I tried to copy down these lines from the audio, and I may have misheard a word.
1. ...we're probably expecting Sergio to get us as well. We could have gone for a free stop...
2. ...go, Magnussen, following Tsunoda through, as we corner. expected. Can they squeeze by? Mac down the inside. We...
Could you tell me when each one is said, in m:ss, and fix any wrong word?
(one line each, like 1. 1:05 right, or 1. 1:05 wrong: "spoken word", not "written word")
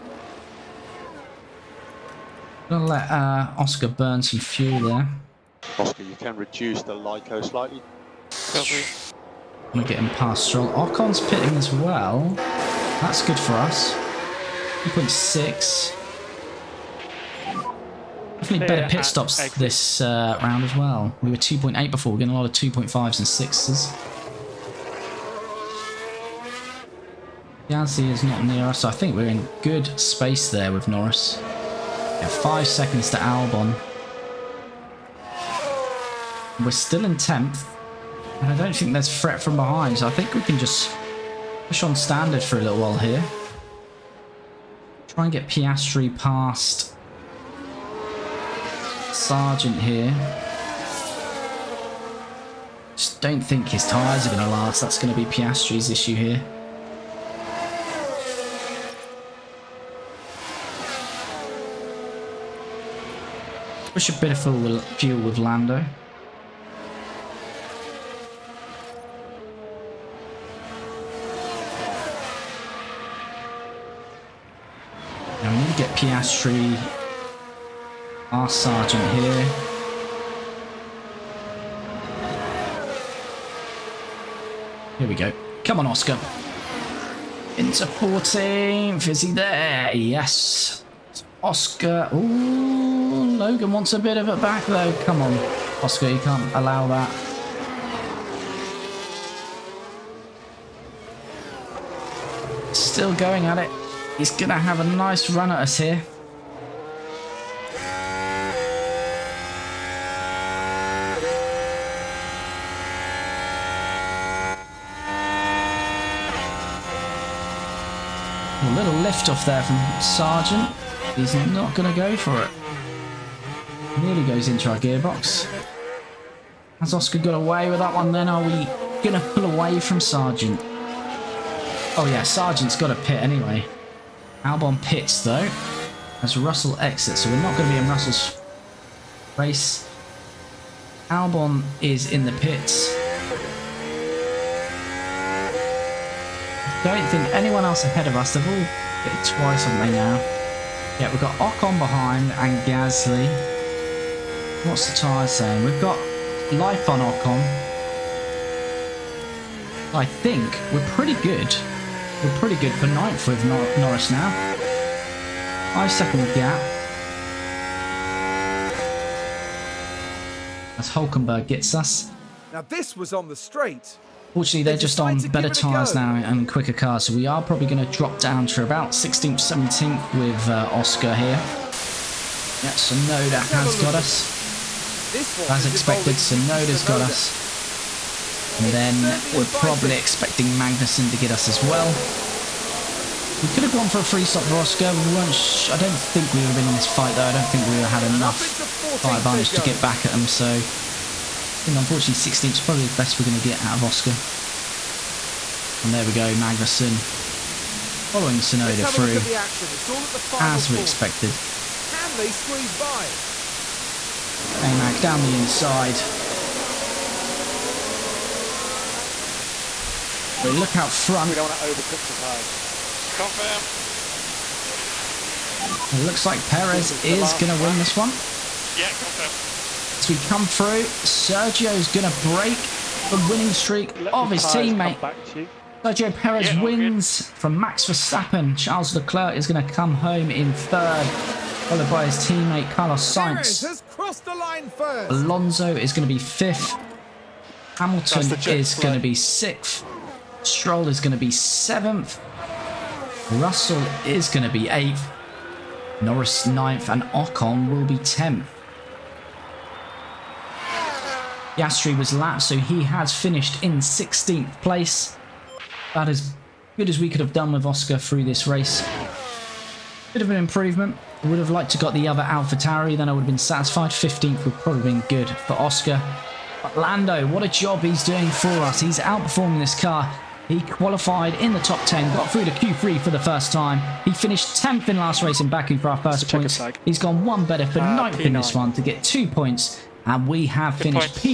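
1. 3:09 wrong: "Magnussen", not "Sergio"
2. 3:26 right.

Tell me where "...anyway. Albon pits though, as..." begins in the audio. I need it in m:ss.
2:13.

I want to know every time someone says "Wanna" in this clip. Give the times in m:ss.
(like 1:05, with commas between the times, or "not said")
0:09.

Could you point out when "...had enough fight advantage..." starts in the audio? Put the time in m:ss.
3:18.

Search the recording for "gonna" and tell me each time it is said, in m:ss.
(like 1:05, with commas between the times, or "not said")
0:02, 1:44, 2:01, 2:09.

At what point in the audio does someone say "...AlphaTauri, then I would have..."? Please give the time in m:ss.
4:32.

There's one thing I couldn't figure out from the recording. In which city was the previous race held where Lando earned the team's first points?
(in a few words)
Baku.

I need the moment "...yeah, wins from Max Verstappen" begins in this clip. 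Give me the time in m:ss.
3:56.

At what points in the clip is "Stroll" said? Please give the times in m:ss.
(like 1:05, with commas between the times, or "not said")
0:10, 4:10.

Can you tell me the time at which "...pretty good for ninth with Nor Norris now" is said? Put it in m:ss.
2:42.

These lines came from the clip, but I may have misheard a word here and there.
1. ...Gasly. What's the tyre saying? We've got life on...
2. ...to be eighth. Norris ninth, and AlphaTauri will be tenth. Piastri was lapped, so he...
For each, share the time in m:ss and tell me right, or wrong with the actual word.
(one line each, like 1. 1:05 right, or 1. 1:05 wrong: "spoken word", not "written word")
1. 2:32 right
2. 4:14 wrong: "Ocon", not "AlphaTauri".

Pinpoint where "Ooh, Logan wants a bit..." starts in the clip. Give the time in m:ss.
1:32.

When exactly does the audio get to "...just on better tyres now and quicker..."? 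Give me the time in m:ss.
2:54.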